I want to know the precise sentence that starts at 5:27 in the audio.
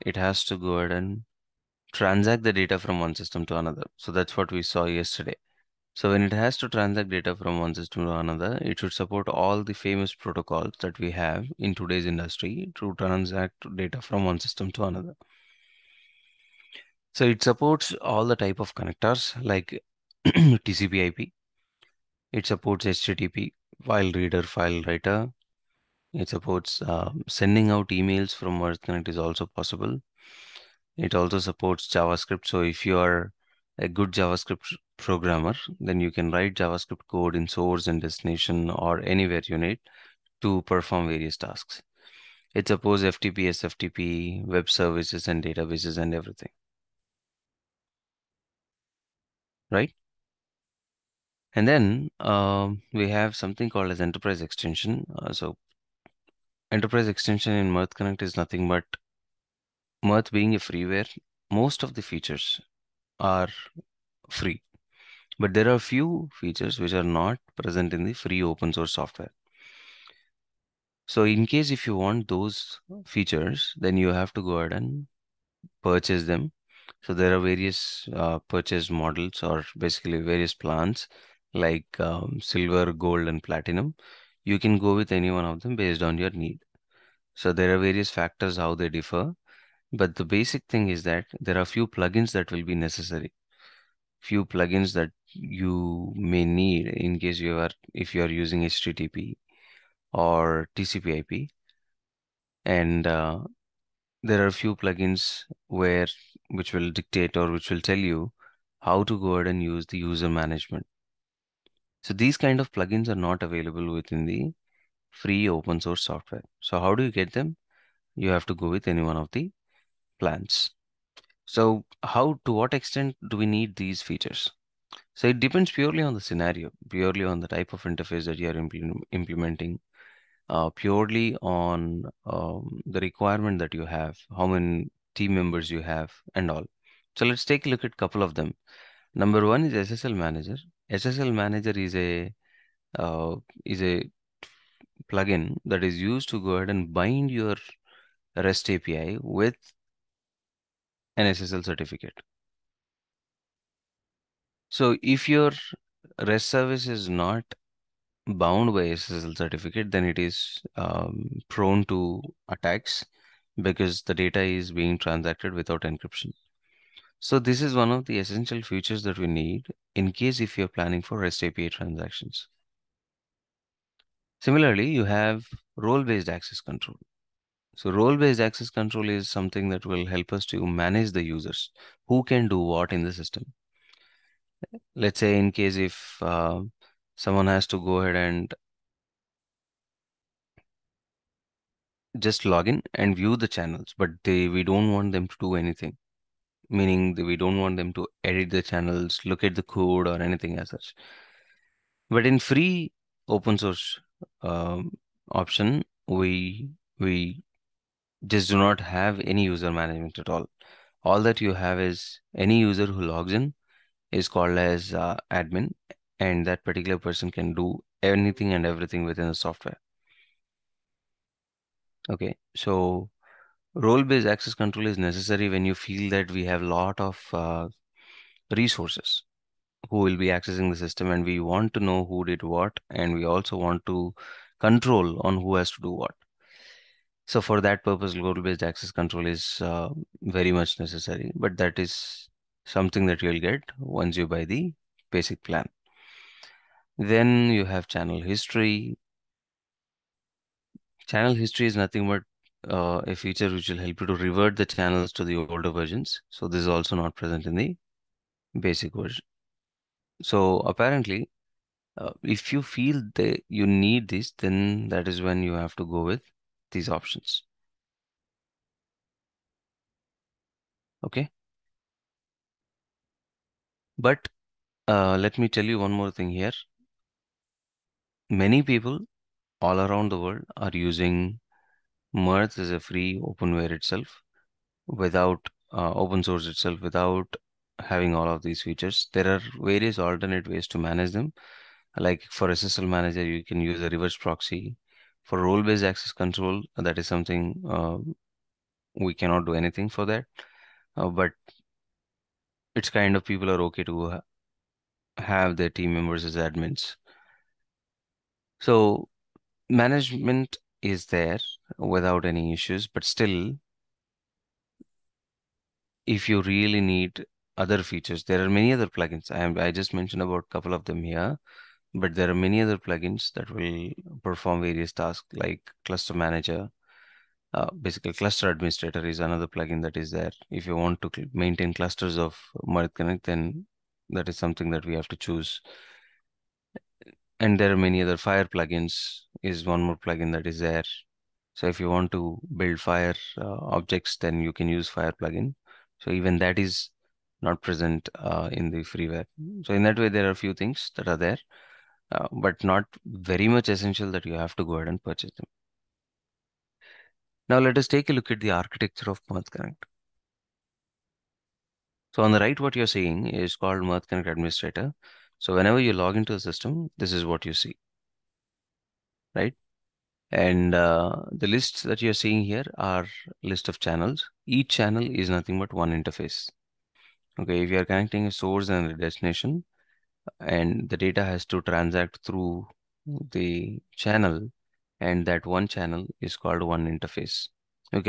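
Uh, basically, cluster administrator is another plugin that is there.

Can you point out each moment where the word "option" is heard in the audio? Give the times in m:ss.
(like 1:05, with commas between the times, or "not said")
3:25, 4:26.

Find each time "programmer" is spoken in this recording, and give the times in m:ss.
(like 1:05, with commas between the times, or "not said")
0:34.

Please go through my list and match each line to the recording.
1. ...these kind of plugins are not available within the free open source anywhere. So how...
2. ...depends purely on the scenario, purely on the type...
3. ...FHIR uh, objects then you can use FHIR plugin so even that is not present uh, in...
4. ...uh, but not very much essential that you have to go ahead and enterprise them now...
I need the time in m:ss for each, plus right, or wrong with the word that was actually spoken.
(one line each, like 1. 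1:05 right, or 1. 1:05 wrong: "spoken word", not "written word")
1. 1:52 wrong: "software", not "anywhere"
2. 2:05 right
3. 5:42 right
4. 5:52 wrong: "purchase", not "enterprise".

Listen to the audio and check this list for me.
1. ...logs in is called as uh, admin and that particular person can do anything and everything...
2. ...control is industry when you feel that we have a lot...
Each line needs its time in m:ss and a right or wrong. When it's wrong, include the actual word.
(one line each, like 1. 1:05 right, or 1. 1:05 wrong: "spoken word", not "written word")
1. 3:33 right
2. 3:44 wrong: "necessary", not "industry".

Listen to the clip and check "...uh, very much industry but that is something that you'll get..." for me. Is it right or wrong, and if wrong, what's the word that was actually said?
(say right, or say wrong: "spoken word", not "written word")
wrong: "necessary", not "industry".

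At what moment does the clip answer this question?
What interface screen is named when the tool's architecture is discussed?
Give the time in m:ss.
6:03.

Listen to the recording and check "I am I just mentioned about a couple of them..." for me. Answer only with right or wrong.
right.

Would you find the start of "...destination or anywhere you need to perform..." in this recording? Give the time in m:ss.
0:38.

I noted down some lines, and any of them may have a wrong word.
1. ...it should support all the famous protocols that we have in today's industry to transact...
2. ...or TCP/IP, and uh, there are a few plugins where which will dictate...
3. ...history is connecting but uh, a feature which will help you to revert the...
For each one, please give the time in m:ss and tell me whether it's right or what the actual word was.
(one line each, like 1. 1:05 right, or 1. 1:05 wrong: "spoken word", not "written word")
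1. 0:08 right
2. 1:40 right
3. 4:11 wrong: "nothing", not "connecting".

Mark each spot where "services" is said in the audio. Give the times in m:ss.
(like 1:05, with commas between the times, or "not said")
0:44, 2:36.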